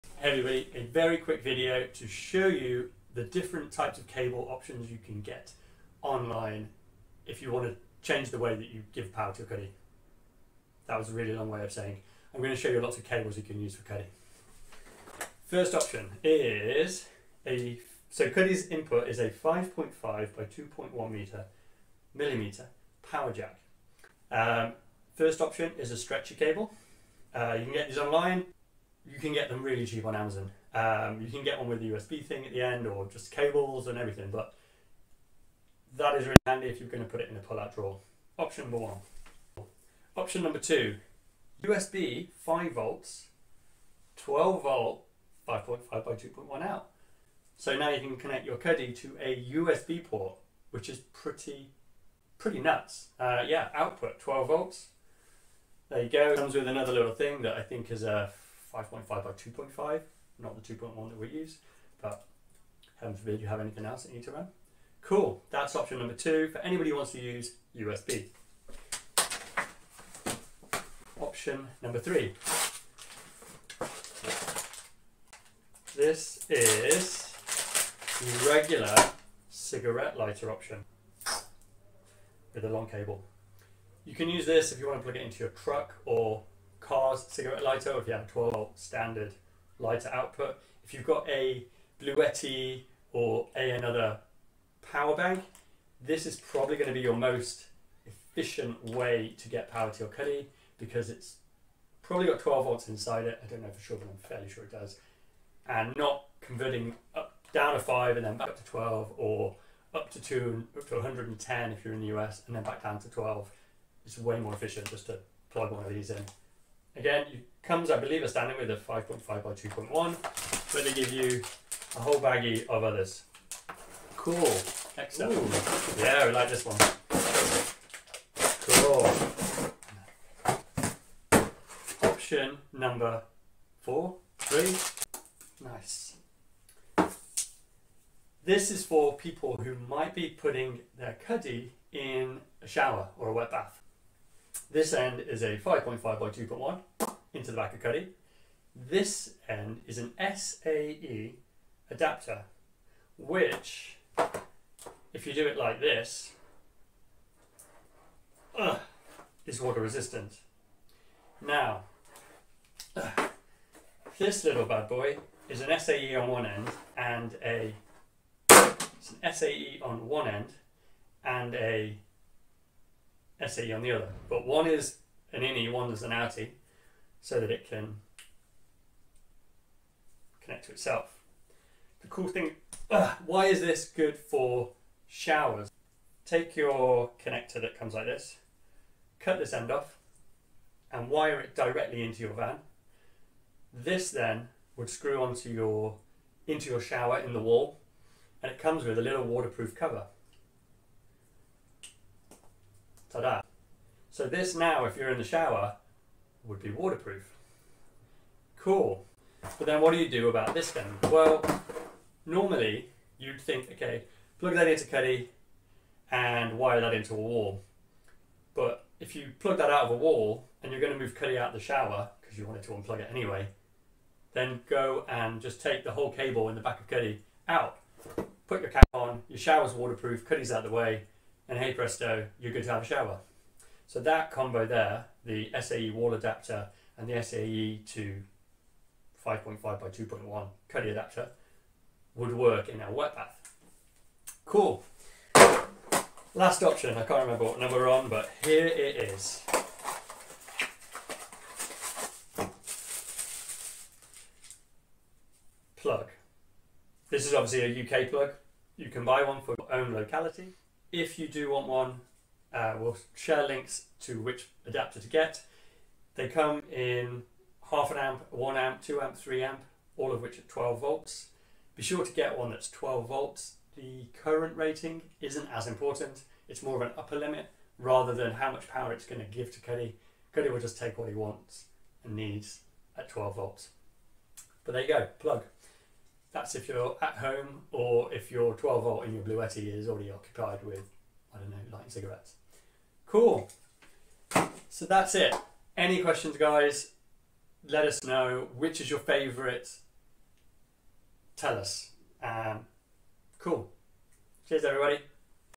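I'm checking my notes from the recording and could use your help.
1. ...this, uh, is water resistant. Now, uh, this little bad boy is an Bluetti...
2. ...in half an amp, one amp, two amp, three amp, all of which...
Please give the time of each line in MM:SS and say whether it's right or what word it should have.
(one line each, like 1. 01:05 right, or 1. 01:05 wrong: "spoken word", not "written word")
1. 02:35 wrong: "SAE", not "Bluetti"
2. 04:26 right.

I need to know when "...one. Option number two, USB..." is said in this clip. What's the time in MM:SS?
00:38.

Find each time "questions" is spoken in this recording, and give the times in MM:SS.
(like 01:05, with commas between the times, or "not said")
04:55.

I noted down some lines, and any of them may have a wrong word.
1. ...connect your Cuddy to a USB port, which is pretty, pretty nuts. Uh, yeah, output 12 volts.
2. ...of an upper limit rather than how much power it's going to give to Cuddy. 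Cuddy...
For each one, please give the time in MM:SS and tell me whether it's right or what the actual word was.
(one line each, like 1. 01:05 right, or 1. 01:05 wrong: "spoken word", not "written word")
1. 00:48 right
2. 04:36 right.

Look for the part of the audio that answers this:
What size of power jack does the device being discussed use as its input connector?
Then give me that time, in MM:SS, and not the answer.
00:19.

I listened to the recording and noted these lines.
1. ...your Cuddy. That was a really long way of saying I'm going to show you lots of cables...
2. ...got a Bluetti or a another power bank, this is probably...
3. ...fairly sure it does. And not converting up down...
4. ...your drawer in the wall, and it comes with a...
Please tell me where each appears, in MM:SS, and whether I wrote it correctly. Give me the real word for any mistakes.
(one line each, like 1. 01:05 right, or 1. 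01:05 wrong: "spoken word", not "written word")
1. 00:09 right
2. 01:31 right
3. 01:44 right
4. 03:16 wrong: "shower", not "drawer".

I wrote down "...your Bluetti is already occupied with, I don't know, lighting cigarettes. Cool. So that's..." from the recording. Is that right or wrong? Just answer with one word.
right.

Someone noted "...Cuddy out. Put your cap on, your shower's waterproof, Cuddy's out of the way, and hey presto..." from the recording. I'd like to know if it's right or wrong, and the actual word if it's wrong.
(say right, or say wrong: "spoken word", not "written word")
right.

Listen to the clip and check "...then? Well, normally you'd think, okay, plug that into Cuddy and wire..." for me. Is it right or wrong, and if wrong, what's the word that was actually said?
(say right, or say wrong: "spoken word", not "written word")
right.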